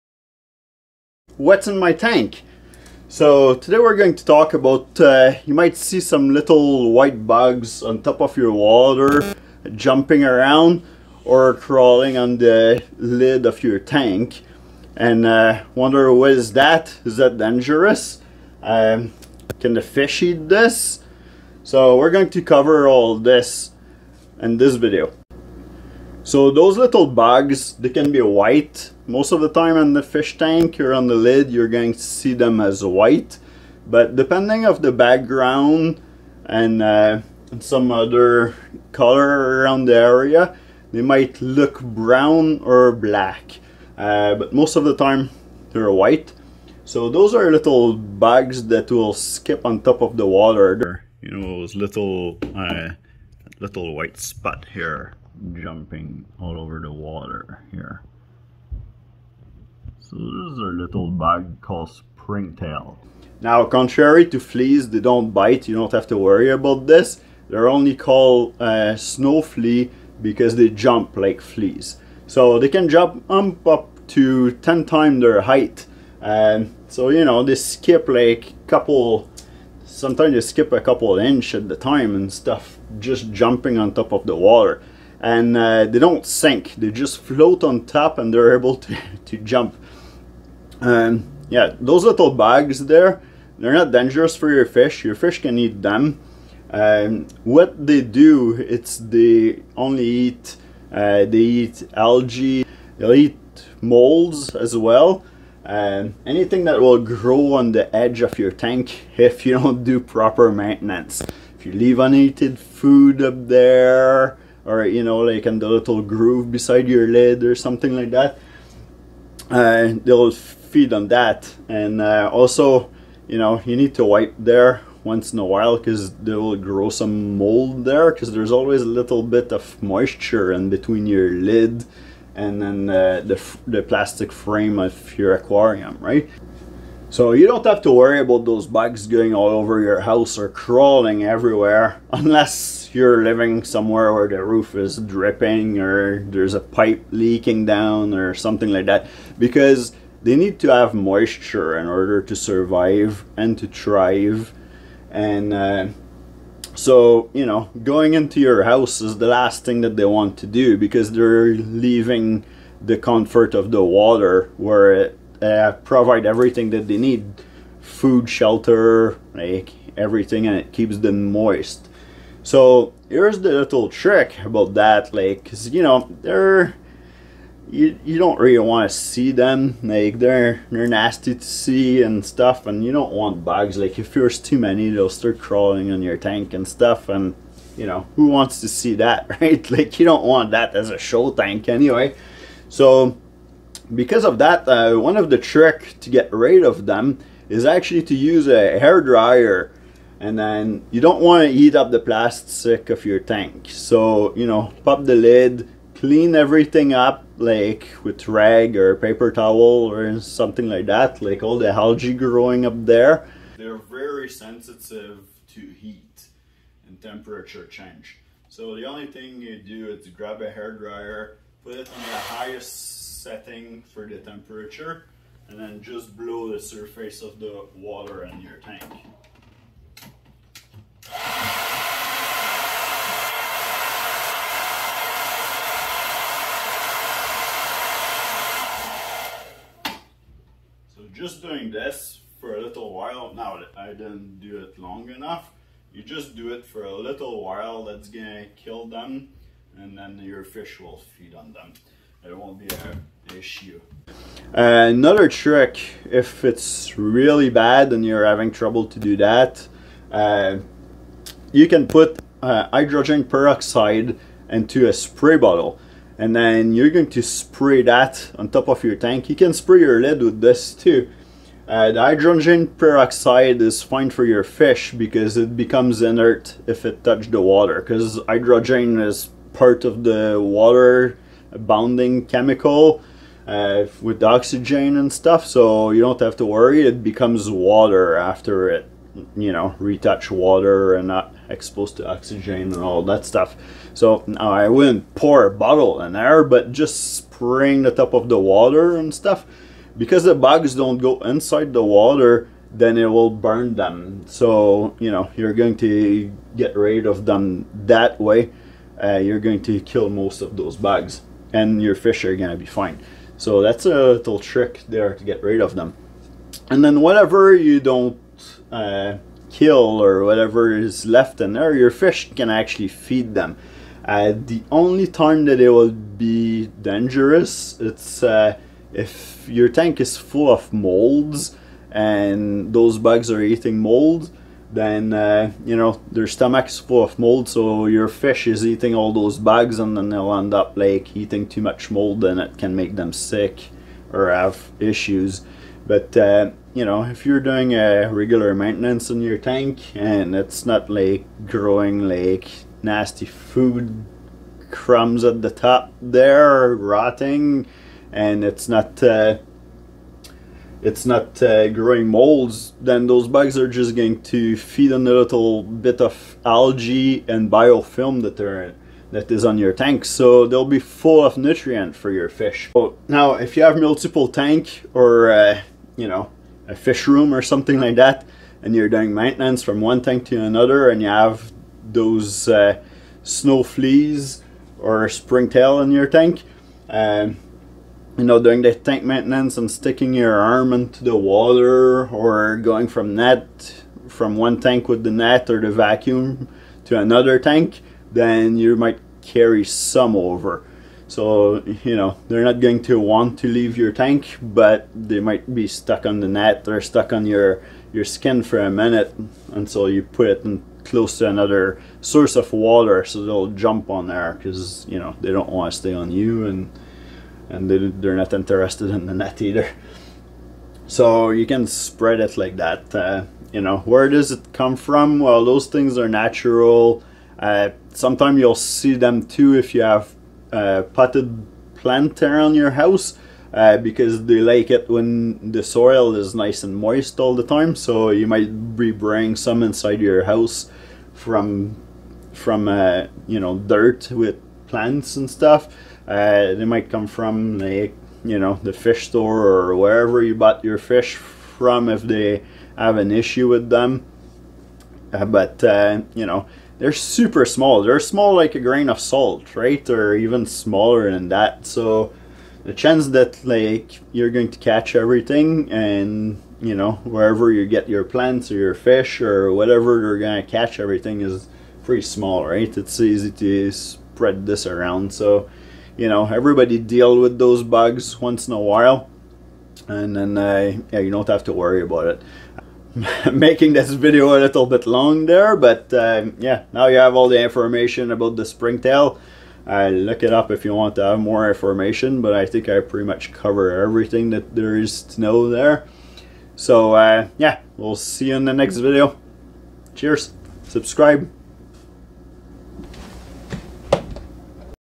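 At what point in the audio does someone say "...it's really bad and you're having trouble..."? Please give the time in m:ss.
4:16.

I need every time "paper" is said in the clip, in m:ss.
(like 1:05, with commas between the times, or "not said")
3:28.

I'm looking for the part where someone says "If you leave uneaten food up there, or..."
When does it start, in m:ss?
1:51.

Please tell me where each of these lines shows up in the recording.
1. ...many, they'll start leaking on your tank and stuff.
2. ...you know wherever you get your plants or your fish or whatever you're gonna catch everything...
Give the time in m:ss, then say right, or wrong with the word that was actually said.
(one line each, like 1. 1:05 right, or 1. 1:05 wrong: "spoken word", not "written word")
1. 3:04 wrong: "crawling", not "leaking"
2. 7:46 right.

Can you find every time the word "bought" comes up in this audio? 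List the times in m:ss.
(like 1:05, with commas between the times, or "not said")
7:30.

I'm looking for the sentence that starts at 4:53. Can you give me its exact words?
So now I wouldn't pour a bottle in there, but just spraying the top of the water and stuff.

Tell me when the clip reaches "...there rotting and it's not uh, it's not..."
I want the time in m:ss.
5:56.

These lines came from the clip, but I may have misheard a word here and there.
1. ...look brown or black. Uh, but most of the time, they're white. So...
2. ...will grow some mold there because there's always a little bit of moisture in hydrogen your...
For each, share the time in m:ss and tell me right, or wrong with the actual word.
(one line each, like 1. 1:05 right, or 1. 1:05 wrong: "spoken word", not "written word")
1. 0:41 right
2. 2:06 wrong: "between", not "hydrogen".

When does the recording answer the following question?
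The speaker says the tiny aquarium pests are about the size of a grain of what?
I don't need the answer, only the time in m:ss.
7:38.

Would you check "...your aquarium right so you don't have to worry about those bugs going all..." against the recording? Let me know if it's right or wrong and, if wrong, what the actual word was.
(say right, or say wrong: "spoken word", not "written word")
right.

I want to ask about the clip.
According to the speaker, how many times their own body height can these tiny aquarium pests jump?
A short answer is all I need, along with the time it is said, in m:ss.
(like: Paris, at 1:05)
10 times, at 1:14.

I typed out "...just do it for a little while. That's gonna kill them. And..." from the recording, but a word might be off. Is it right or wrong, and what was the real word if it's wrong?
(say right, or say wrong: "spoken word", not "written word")
right.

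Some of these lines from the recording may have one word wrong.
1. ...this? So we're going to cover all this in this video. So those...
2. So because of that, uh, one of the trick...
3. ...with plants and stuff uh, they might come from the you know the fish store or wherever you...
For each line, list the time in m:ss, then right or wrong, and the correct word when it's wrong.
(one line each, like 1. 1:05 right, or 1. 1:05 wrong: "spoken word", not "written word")
1. 0:20 right
2. 3:12 right
3. 7:24 right.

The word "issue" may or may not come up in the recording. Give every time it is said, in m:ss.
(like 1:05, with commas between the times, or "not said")
4:13, 5:44, 7:33.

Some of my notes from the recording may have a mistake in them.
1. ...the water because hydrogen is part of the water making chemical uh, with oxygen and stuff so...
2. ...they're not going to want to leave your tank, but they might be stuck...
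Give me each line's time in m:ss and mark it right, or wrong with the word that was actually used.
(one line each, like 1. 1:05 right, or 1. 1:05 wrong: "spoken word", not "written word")
1. 4:37 wrong: "bounding", not "making"
2. 6:42 right.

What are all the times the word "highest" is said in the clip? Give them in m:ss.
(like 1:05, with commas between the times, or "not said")
3:42.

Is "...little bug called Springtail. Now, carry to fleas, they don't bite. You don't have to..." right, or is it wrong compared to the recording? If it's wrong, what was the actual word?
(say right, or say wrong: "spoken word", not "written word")
wrong: "contrary", not "carry".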